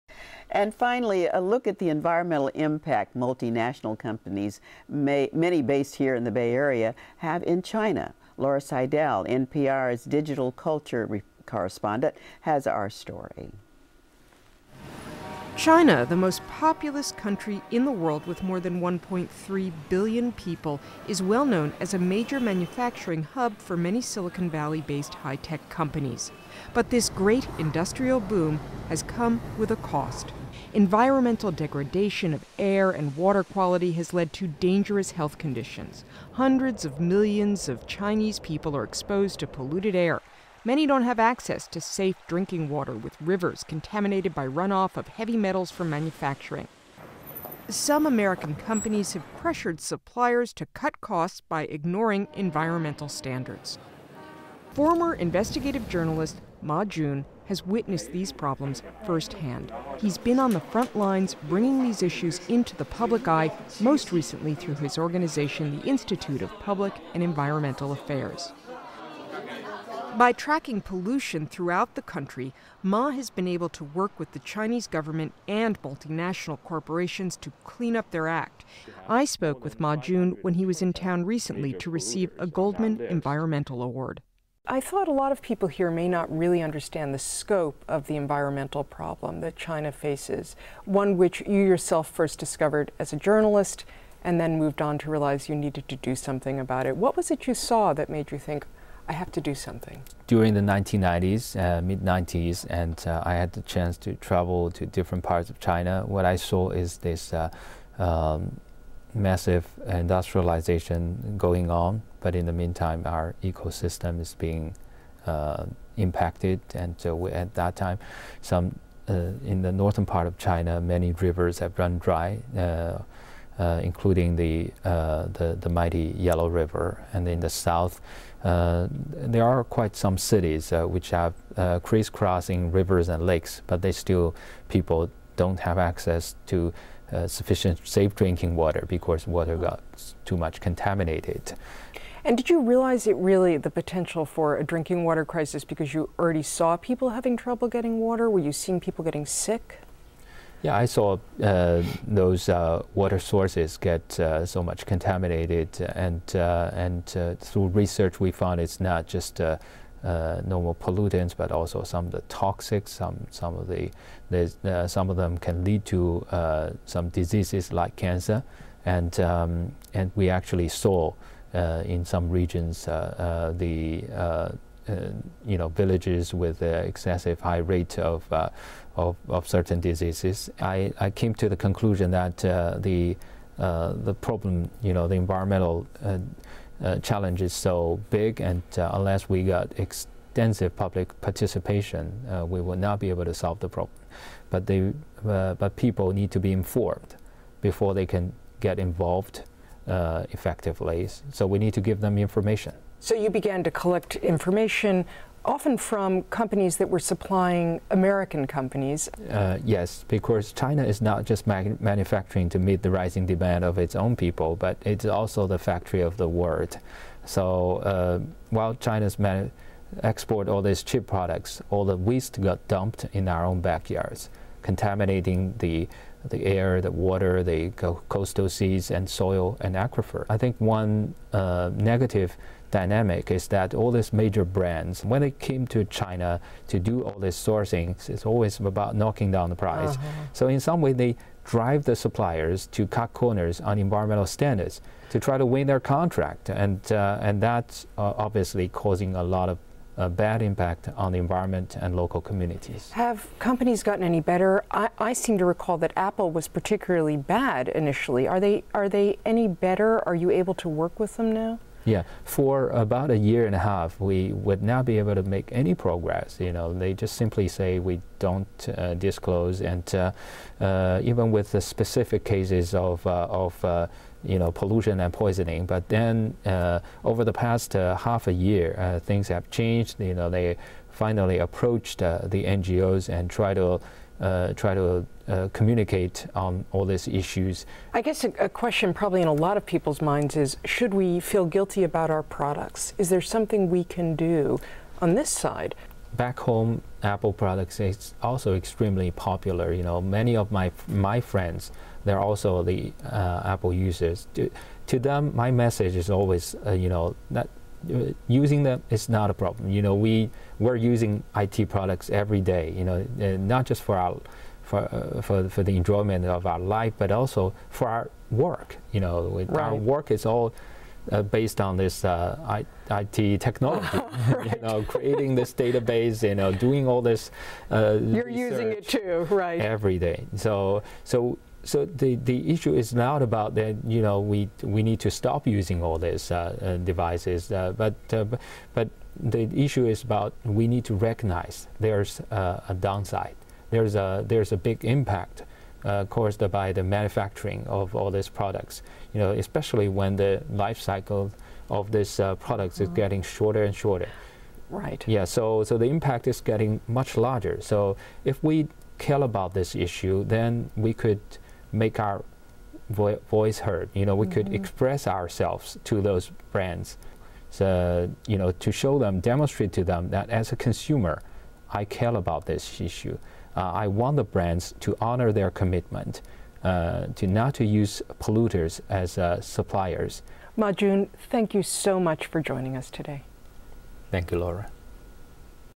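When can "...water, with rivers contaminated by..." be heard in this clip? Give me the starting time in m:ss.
0:42.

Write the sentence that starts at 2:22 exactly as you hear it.
And did you realize it really the potential for a drinking water crisis because you already saw people having trouble getting water?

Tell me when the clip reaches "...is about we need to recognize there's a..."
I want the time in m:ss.
5:39.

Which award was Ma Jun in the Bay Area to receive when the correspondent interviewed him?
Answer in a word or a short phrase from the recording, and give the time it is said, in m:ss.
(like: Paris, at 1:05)
Goldman Environmental Award, at 1:22.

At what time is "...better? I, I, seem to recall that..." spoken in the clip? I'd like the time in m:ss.
4:14.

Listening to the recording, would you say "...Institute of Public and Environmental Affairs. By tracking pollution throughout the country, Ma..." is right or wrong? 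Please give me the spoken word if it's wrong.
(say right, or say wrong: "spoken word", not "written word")
right.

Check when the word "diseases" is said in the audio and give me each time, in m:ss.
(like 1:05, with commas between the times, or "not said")
2:47, 2:59.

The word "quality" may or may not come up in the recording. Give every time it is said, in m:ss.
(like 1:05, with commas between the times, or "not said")
0:33.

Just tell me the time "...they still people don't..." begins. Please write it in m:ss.
2:13.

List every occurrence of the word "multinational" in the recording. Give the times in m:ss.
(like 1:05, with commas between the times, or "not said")
0:03, 1:15.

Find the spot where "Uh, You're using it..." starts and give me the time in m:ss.
5:27.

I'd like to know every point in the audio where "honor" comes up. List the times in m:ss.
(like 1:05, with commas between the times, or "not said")
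6:14.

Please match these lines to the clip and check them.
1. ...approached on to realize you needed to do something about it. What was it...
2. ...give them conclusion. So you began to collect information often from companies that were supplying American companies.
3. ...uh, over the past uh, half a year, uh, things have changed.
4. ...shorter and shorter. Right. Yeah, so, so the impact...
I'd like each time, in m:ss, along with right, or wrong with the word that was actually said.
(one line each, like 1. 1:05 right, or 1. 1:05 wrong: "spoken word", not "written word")
1. 1:34 wrong: "moved", not "approached"
2. 3:21 wrong: "information", not "conclusion"
3. 4:36 right
4. 5:53 right.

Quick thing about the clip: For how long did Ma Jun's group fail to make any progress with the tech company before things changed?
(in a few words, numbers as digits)
a year and a half.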